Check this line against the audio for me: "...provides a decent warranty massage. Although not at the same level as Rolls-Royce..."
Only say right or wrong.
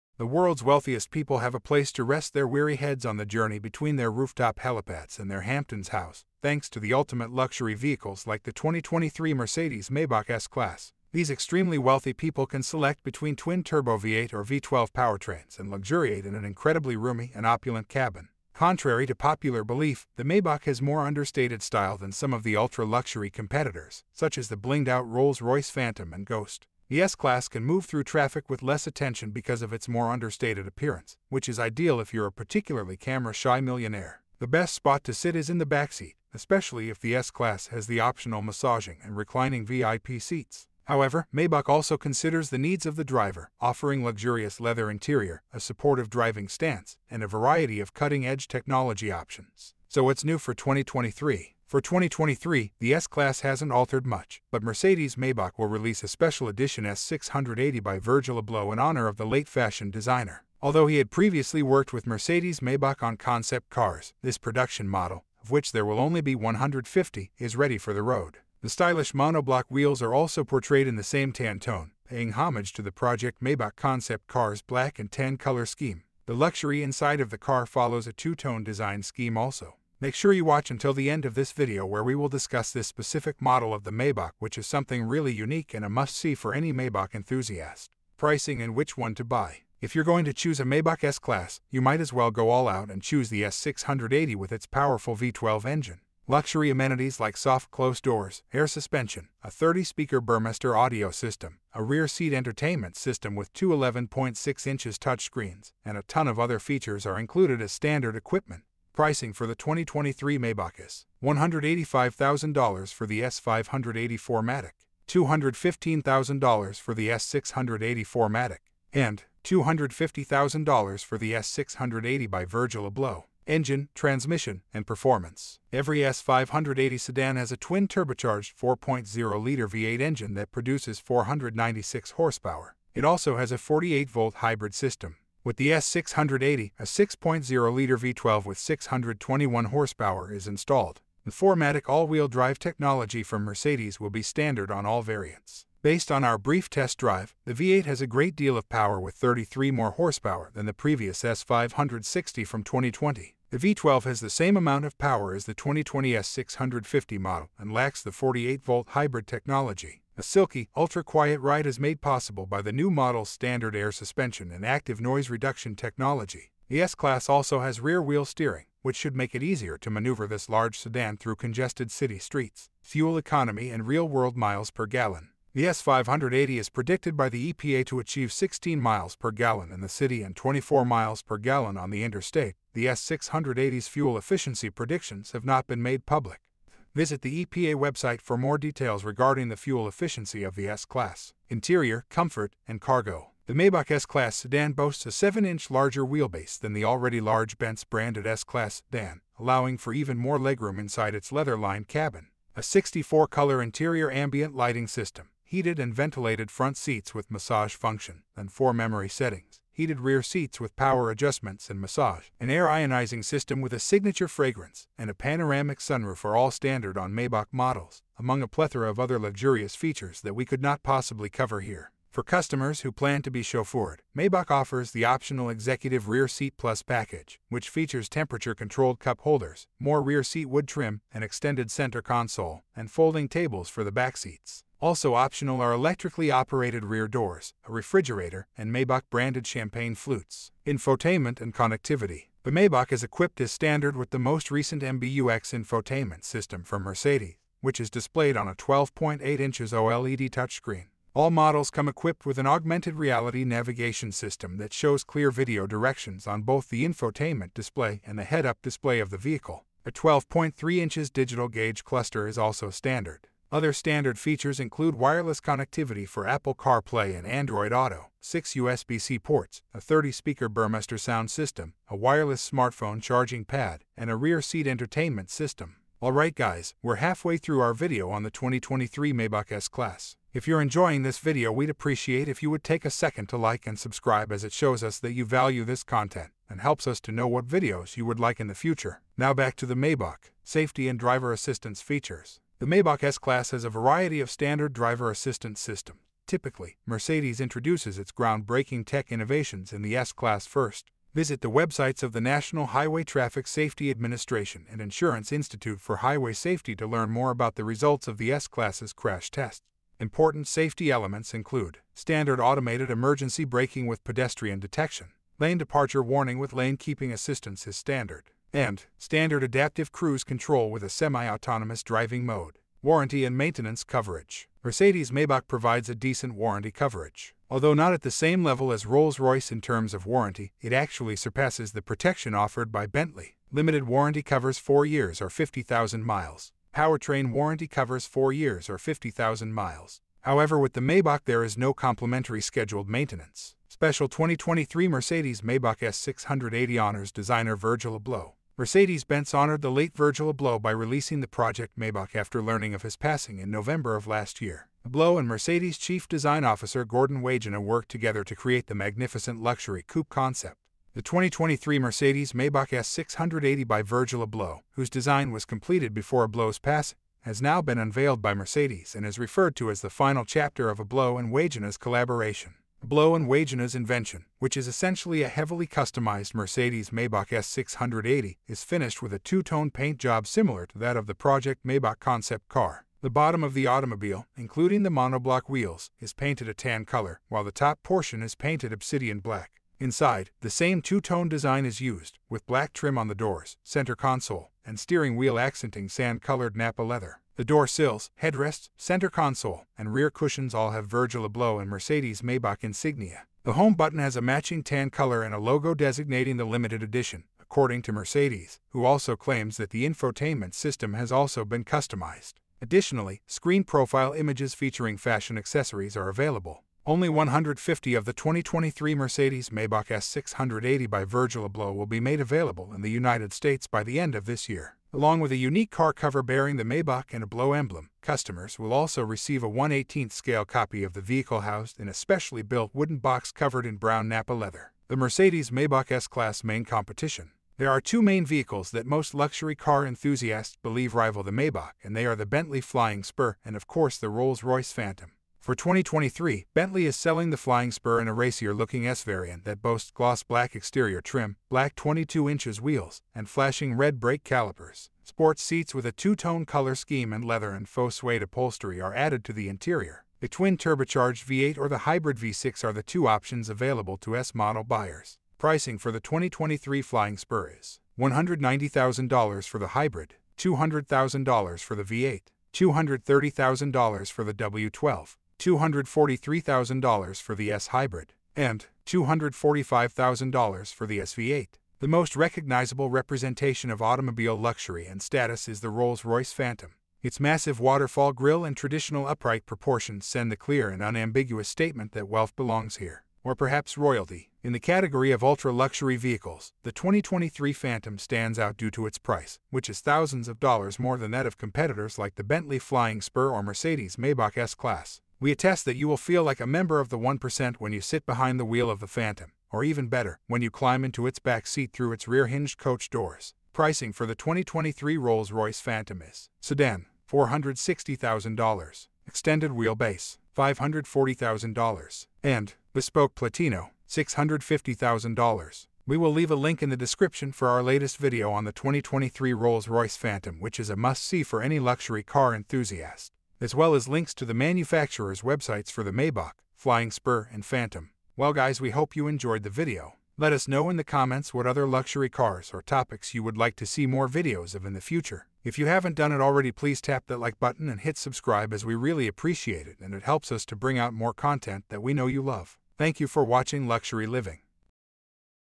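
wrong.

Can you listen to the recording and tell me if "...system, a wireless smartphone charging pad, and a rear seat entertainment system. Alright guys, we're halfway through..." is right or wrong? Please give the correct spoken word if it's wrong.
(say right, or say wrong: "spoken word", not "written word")
right.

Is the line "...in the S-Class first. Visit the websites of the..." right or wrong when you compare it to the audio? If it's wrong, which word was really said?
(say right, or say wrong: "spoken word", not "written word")
right.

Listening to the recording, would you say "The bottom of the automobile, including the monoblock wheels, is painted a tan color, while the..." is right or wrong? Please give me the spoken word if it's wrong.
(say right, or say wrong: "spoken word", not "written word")
right.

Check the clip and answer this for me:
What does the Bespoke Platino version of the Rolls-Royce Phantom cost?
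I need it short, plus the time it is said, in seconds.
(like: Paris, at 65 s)
$650,000, at 523 s.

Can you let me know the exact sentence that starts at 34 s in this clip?
The best spot to sit is in the backseat, especially if the S-Class has the optional massaging and reclining VIP seats.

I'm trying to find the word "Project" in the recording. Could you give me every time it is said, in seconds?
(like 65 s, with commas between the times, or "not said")
72 s, 351 s, 381 s.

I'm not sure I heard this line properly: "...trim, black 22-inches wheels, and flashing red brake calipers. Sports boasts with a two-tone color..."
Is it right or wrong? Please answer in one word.
wrong.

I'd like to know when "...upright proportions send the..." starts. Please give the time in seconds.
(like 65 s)
489 s.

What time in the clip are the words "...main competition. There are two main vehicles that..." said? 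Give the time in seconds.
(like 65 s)
436 s.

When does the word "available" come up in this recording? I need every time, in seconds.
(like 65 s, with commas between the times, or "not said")
416 s, 422 s, 463 s.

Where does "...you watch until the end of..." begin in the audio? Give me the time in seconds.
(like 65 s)
80 s.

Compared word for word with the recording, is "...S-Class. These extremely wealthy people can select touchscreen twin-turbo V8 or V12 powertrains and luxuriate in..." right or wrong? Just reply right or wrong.
wrong.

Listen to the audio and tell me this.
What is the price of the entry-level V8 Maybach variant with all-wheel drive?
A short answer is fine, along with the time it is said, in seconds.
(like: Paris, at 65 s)
$185,000, at 111 s.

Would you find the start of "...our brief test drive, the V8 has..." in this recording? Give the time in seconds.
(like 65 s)
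146 s.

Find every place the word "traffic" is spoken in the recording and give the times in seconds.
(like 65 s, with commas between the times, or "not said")
28 s, 303 s.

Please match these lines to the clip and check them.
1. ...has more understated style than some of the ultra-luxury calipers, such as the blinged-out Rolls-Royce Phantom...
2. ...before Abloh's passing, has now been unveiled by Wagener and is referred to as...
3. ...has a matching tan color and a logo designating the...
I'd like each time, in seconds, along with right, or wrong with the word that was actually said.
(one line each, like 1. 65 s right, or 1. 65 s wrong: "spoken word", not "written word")
1. 20 s wrong: "competitors", not "calipers"
2. 365 s wrong: "Mercedes", not "Wagener"
3. 403 s right.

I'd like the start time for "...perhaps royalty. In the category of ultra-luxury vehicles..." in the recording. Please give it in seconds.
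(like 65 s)
493 s.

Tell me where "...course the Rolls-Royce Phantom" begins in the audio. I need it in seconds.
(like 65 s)
443 s.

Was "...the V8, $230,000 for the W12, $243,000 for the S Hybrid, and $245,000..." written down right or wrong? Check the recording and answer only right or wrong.
right.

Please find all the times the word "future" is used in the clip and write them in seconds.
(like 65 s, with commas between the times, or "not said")
288 s, 544 s.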